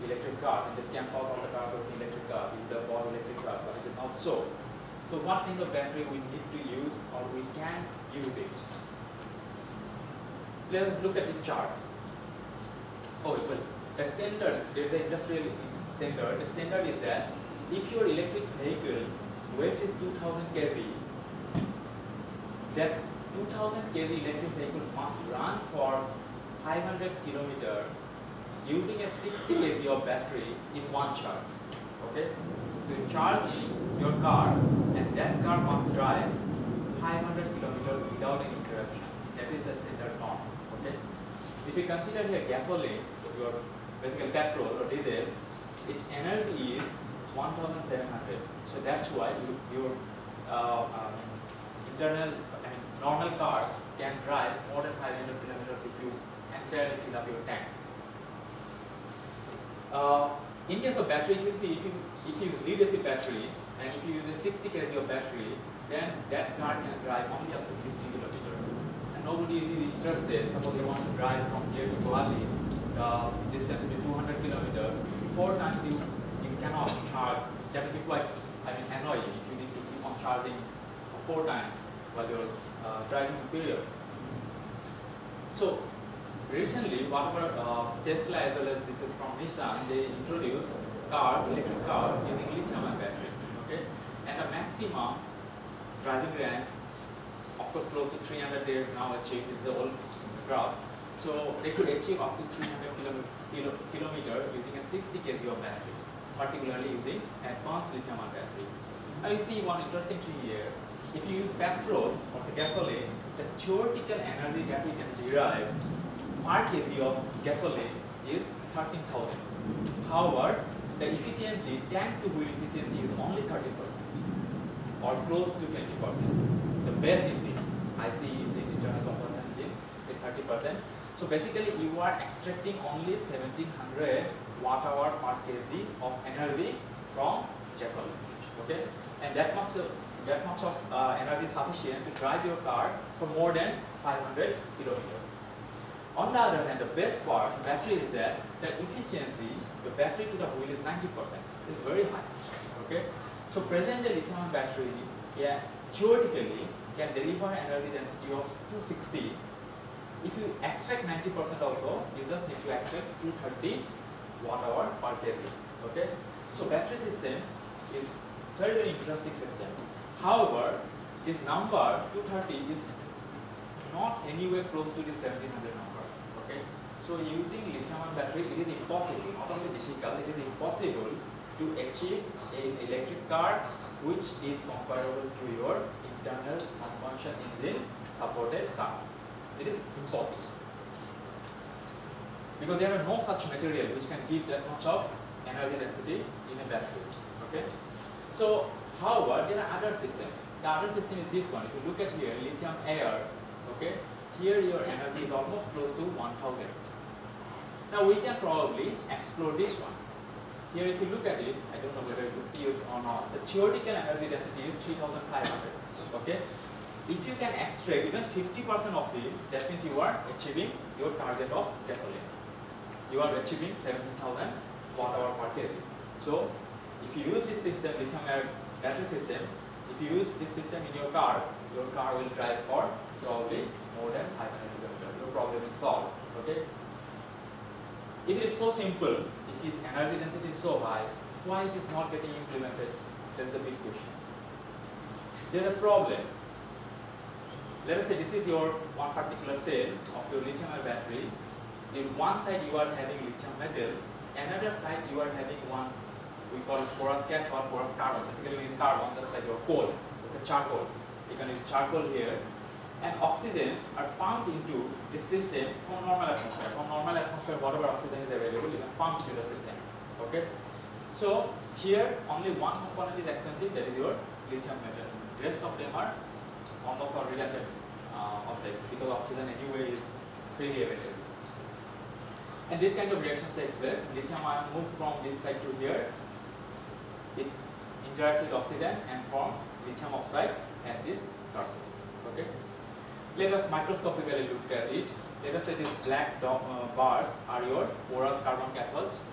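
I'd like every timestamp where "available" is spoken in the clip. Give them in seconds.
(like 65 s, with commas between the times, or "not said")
268 s, 280 s.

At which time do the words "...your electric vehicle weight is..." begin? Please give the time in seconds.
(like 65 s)
17 s.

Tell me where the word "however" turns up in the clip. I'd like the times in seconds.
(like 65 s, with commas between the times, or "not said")
120 s, 170 s, 199 s.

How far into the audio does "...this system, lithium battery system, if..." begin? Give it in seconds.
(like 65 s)
227 s.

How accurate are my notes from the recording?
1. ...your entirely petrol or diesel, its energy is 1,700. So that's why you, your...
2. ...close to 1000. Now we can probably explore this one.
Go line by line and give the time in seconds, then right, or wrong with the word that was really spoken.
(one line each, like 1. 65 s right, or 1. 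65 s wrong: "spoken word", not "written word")
1. 43 s wrong: "basically", not "entirely"
2. 205 s right.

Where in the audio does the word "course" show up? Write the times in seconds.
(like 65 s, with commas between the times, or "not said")
97 s.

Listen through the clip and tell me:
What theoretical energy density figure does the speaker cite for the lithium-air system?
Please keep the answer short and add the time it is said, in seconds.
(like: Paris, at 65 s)
3500, at 214 s.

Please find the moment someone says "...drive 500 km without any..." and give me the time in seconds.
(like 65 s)
35 s.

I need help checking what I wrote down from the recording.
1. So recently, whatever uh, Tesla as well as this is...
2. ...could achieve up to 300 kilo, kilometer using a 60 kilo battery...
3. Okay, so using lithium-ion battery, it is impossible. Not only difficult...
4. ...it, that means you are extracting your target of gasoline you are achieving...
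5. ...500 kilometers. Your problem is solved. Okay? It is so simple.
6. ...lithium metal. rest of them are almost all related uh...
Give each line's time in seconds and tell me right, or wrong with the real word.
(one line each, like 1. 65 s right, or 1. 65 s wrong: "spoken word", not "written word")
1. 85 s right
2. 101 s right
3. 176 s right
4. 219 s wrong: "achieving", not "extracting"
5. 234 s right
6. 274 s right.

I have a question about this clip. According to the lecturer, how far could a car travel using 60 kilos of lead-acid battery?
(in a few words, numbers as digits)
50 kilometers.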